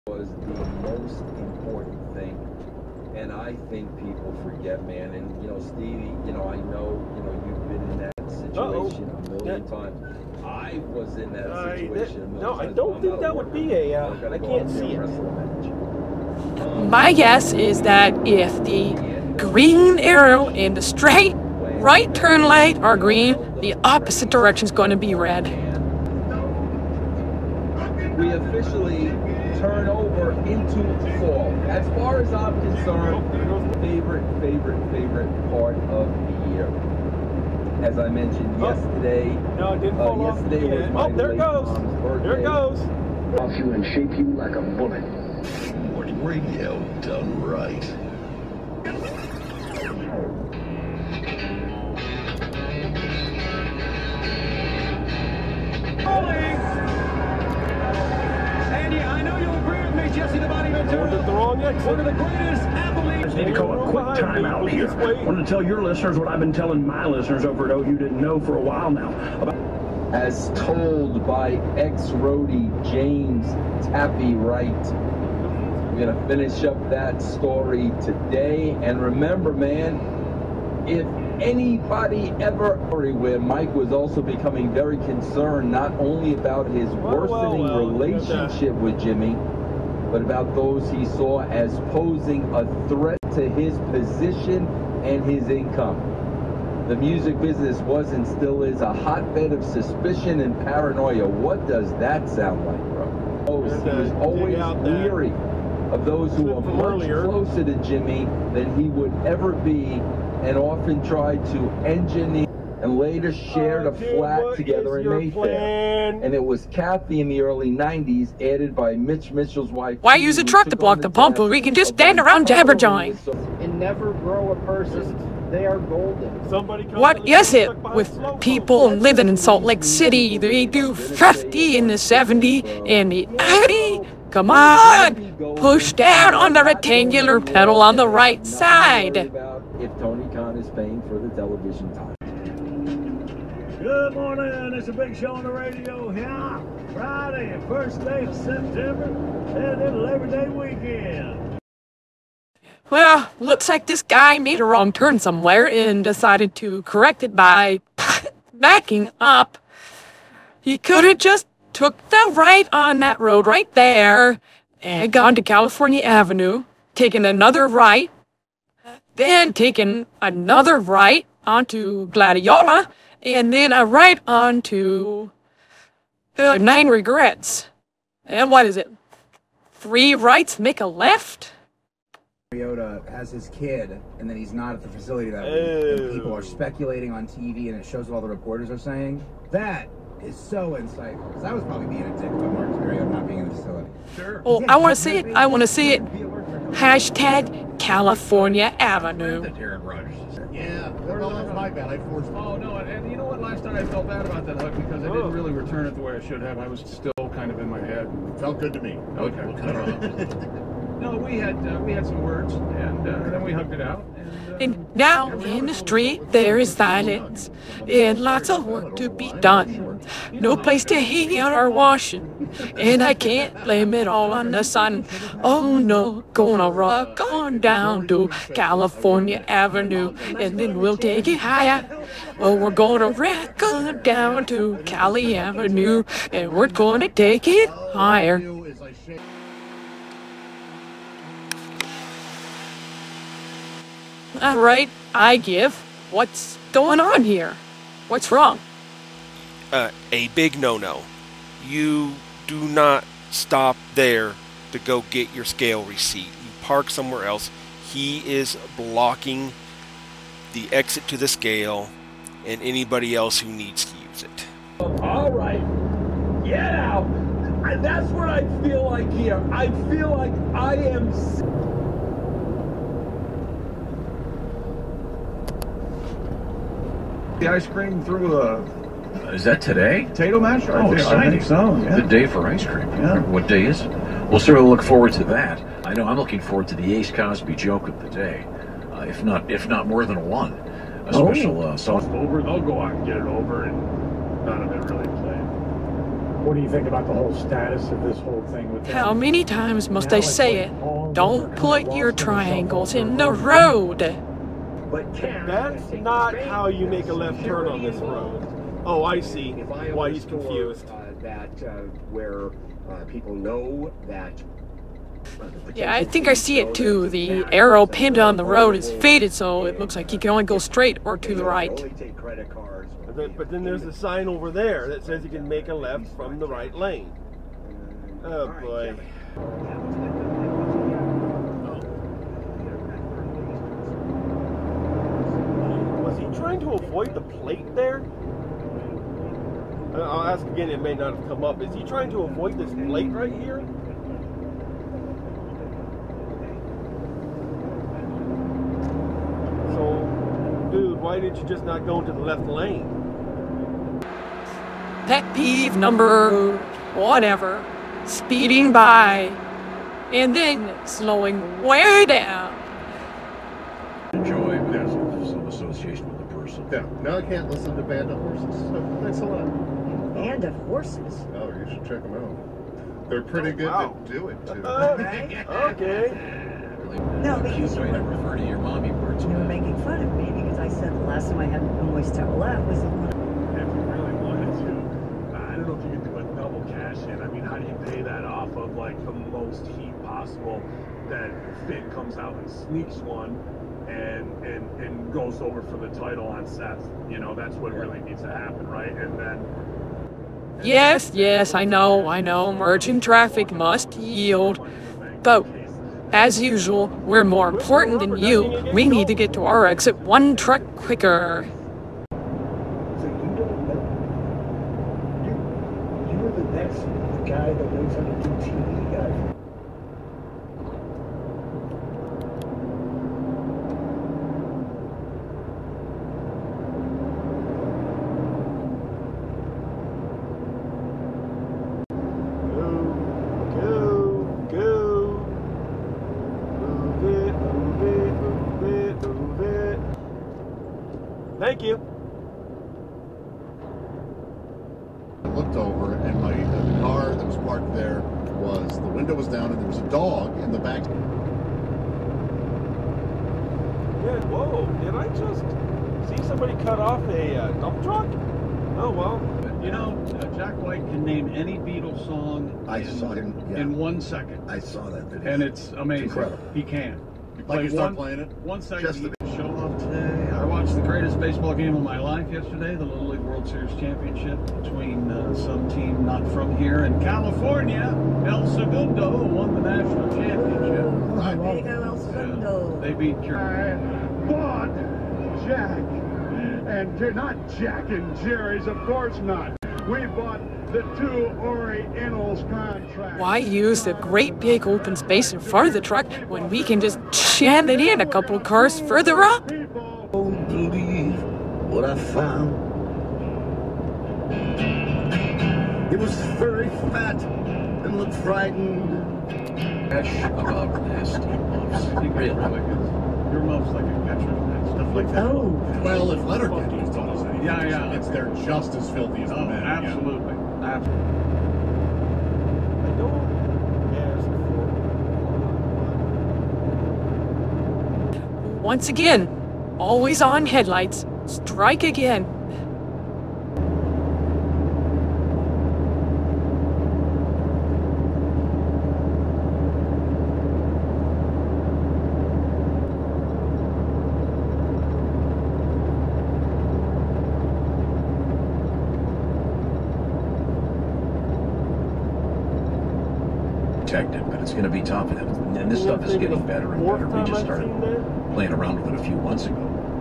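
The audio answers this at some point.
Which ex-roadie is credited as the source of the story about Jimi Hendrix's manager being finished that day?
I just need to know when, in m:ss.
1:12.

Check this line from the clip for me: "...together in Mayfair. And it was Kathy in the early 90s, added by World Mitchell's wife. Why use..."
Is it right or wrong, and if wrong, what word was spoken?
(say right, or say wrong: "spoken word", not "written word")
wrong: "Mitch", not "World".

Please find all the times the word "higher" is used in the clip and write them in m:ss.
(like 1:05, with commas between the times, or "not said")
3:51, 3:57.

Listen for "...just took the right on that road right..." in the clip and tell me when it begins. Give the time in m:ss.
2:41.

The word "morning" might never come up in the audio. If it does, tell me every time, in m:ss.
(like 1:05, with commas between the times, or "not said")
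0:45, 2:24.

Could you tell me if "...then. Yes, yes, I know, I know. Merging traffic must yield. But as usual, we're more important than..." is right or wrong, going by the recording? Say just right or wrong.
right.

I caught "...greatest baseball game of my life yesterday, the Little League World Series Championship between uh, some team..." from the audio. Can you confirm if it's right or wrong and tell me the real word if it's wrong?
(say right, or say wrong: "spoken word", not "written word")
right.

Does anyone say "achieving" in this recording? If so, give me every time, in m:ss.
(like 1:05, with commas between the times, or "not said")
not said.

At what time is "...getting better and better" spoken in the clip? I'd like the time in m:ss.
9:16.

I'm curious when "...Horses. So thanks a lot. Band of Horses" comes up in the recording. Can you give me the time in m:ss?
6:08.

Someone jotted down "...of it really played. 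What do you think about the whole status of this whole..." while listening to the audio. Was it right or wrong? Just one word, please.
right.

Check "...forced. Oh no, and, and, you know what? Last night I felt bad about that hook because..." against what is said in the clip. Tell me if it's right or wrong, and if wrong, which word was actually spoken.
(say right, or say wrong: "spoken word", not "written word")
right.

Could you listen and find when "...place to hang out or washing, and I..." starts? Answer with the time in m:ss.
3:40.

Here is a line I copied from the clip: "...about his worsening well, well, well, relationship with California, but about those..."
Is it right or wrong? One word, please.
wrong.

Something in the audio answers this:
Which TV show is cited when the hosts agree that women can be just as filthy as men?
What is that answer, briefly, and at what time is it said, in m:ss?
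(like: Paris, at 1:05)
Letterkenny, at 8:36.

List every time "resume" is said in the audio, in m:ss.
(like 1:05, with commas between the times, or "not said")
not said.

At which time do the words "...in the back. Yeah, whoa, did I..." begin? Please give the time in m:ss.
7:30.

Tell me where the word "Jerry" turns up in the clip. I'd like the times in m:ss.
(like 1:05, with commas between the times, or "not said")
8:03, 8:08.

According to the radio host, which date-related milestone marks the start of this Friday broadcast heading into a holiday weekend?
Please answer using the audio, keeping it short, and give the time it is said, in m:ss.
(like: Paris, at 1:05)
First day of September, at 2:27.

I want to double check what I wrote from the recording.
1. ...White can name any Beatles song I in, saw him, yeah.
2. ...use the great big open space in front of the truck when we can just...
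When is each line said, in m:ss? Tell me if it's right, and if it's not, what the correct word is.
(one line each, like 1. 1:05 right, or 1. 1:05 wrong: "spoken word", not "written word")
1. 7:40 right
2. 8:13 right.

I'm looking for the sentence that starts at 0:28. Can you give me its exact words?
We officially turn over into fall.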